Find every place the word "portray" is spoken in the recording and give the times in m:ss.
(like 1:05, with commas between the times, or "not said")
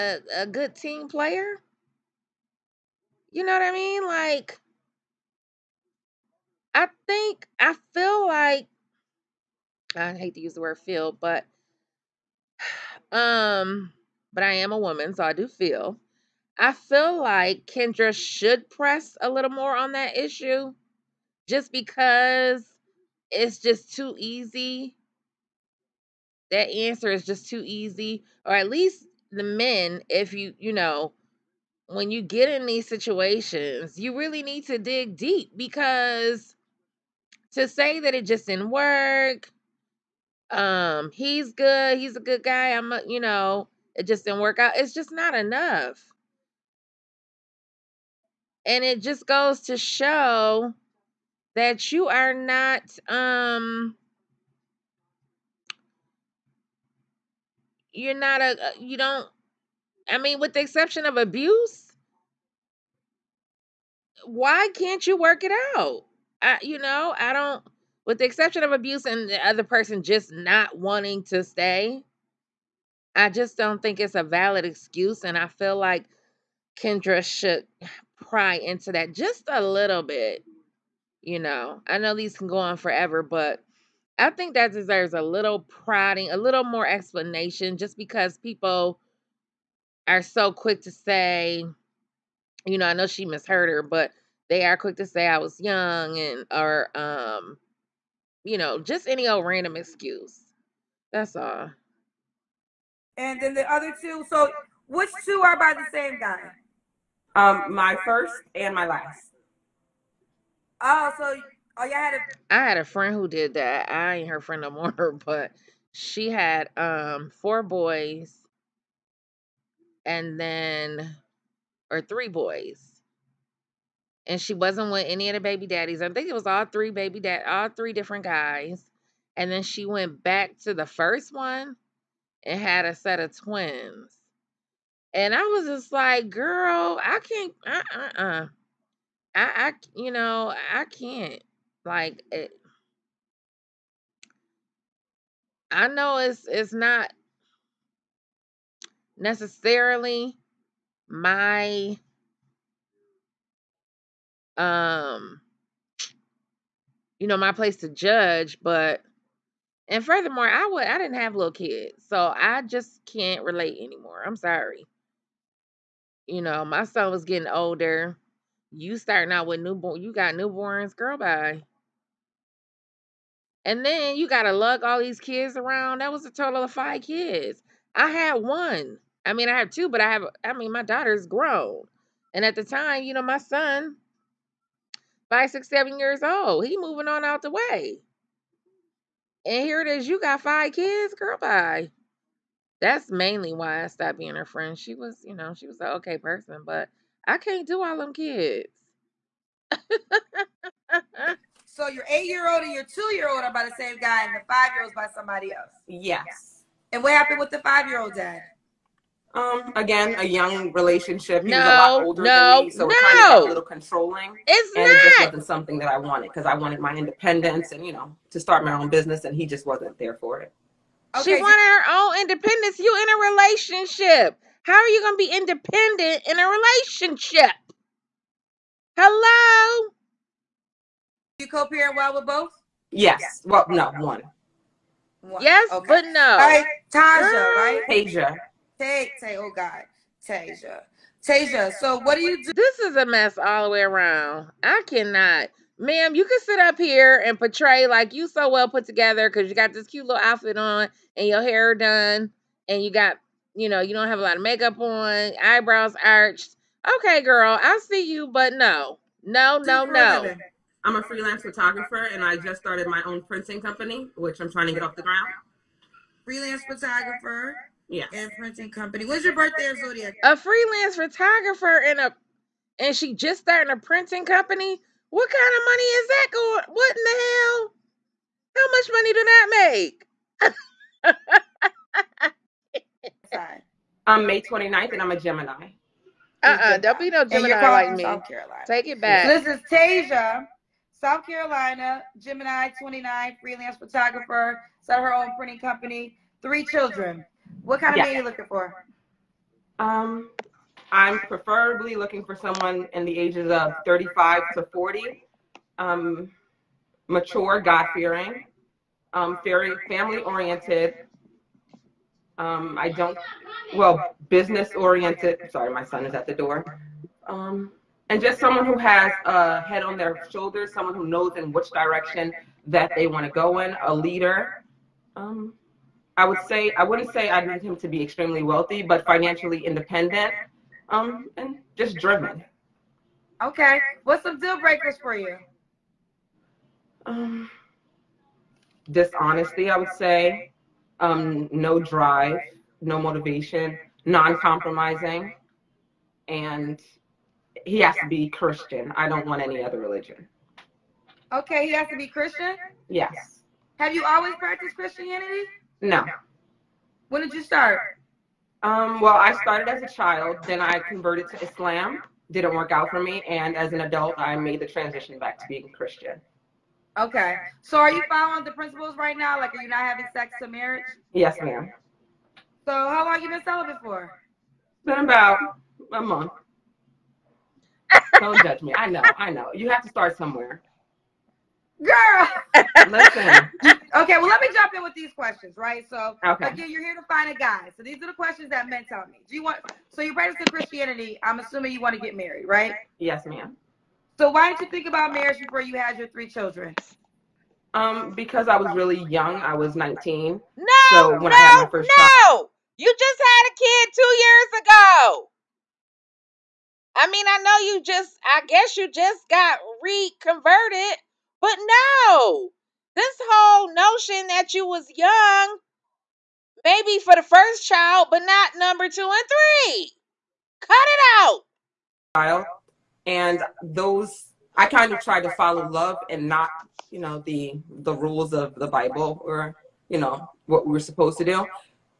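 4:07.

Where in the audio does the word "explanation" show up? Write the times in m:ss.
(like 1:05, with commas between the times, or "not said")
1:26.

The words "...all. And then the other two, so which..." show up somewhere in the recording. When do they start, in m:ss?
1:41.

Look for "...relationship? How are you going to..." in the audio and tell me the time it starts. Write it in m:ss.
3:43.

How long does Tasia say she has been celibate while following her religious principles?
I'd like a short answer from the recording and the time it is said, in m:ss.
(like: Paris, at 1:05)
About a month, at 6:15.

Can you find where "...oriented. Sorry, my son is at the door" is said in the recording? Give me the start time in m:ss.
5:14.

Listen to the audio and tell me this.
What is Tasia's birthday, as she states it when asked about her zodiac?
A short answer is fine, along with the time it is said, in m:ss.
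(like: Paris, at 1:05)
May 29th, at 4:44.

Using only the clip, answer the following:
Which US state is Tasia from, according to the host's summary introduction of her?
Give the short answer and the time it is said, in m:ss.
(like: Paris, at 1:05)
South Carolina, at 4:51.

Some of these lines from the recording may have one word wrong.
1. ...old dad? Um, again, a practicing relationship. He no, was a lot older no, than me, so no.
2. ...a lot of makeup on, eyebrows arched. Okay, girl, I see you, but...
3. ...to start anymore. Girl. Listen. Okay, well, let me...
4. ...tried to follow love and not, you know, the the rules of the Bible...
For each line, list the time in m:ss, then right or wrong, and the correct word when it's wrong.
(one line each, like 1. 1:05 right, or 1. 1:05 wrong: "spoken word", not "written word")
1. 3:28 wrong: "young", not "practicing"
2. 4:14 right
3. 6:19 wrong: "somewhere", not "anymore"
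4. 7:04 right.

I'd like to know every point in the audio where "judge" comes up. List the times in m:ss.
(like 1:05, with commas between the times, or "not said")
2:37, 6:18.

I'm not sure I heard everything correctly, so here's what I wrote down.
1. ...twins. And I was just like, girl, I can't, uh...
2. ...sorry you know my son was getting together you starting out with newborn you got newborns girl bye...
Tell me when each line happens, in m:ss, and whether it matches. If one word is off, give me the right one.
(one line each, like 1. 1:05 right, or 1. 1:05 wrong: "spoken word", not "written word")
1. 2:13 right
2. 2:44 wrong: "older", not "together".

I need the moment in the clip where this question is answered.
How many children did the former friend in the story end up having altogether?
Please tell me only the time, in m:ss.
2:56.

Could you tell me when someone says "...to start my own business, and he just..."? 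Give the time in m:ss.
3:38.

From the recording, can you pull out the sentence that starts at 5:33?
Okay, what's some deal breakers for you?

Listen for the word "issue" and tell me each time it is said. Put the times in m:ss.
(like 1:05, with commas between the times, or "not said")
0:20.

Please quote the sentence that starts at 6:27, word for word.
So, these are the questions that men tell me.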